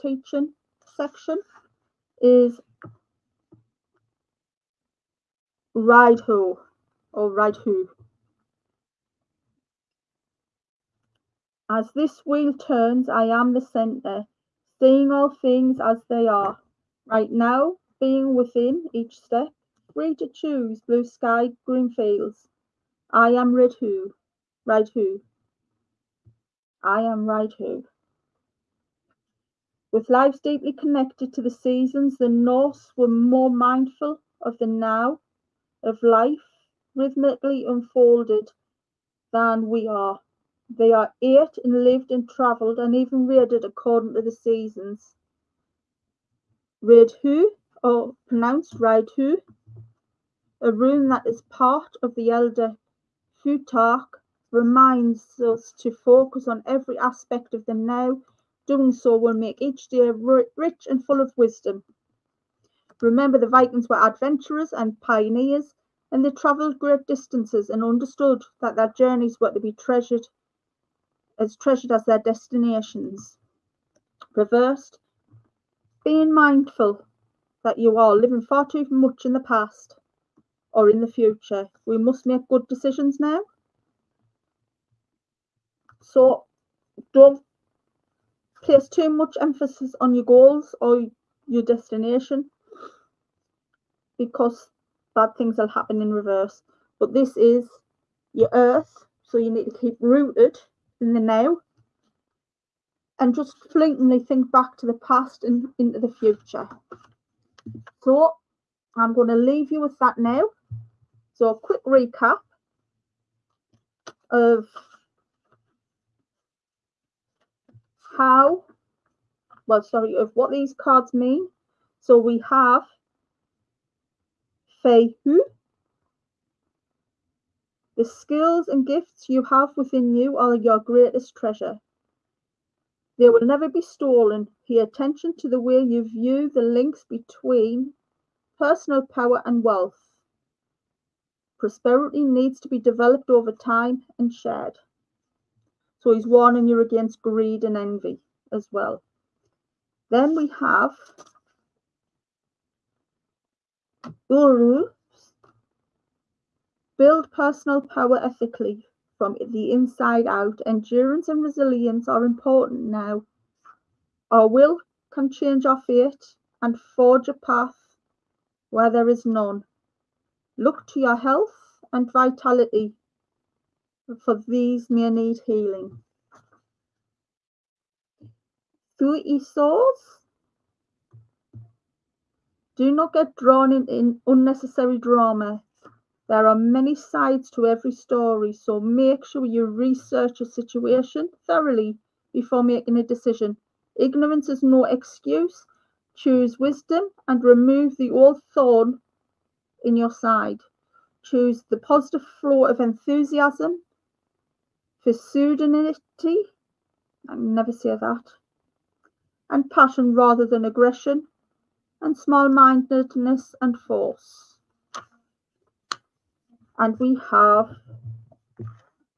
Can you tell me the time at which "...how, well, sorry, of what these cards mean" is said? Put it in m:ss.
1:58.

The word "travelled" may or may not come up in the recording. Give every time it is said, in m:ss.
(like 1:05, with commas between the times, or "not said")
0:42, 1:06.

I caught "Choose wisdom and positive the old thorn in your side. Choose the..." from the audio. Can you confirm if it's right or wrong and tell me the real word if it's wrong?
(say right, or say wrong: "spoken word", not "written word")
wrong: "remove", not "positive".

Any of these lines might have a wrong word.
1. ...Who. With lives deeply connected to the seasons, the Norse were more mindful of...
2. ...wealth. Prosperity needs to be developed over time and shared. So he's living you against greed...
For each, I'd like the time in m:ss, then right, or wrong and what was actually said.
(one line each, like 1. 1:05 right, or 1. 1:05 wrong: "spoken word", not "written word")
1. 0:27 right
2. 2:19 wrong: "warning", not "living".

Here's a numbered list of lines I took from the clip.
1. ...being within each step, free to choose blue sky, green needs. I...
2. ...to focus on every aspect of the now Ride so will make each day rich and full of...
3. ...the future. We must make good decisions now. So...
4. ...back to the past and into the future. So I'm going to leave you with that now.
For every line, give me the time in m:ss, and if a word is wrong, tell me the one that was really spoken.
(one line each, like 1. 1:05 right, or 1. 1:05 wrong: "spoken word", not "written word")
1. 0:17 wrong: "fields", not "needs"
2. 0:55 wrong: "Doing", not "Ride"
3. 1:21 right
4. 1:44 right.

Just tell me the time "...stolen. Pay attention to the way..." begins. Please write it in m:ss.
2:13.